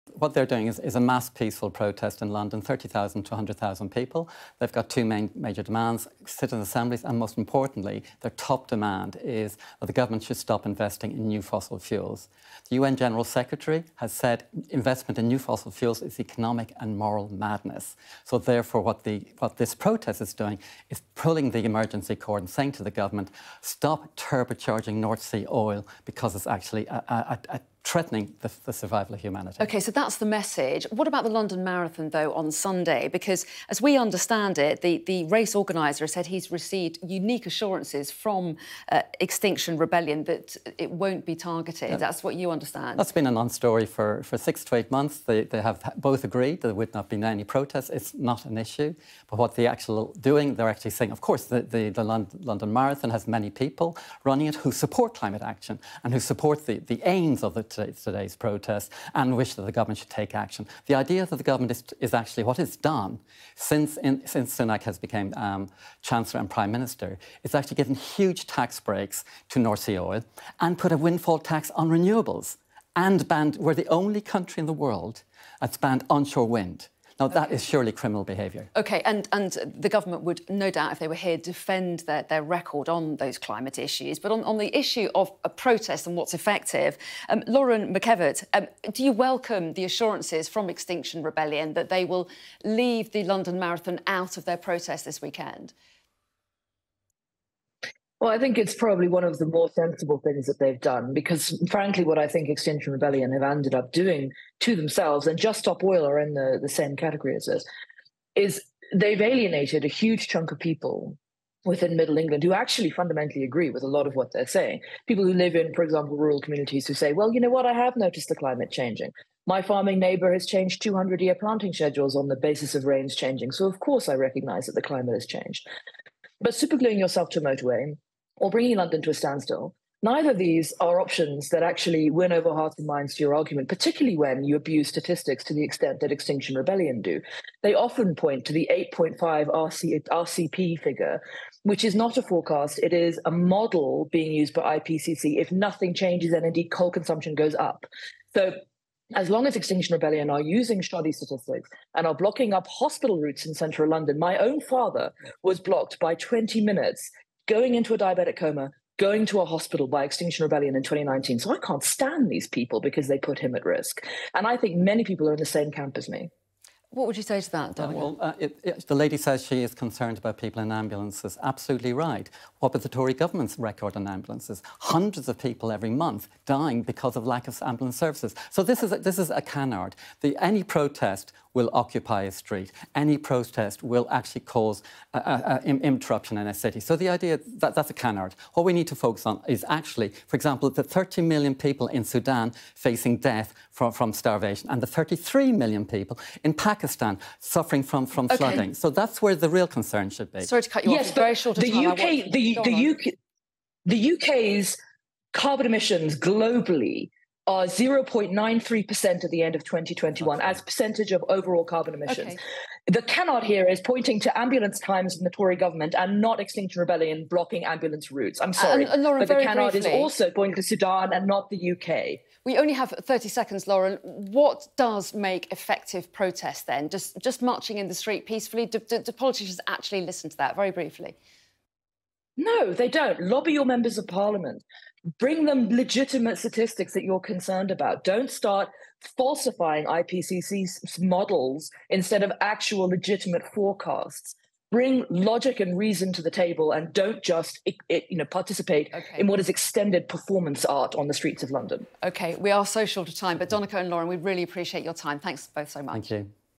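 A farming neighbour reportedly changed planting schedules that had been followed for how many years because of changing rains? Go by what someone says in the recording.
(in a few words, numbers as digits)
200.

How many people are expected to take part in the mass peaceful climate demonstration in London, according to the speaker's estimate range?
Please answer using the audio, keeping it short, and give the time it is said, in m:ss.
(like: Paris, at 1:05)
30,000 to 100,000, at 0:02.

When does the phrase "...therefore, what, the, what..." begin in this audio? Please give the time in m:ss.
0:18.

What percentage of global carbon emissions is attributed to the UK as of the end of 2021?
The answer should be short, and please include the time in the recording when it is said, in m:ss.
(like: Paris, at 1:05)
0.93%, at 3:27.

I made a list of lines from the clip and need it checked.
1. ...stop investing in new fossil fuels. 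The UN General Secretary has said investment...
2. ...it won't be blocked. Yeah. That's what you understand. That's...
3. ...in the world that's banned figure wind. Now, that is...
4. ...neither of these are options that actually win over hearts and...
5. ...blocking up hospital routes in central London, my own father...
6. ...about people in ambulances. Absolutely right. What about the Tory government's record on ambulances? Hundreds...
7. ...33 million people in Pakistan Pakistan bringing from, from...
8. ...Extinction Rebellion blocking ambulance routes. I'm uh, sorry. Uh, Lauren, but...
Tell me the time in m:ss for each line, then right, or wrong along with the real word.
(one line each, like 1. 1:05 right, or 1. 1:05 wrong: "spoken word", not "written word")
1. 0:10 right
2. 0:40 wrong: "targeted", not "blocked"
3. 1:14 wrong: "onshore", not "figure"
4. 2:10 right
5. 2:32 right
6. 2:50 right
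7. 3:14 wrong: "suffering", not "bringing"
8. 3:36 right.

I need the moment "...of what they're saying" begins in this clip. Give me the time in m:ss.
1:54.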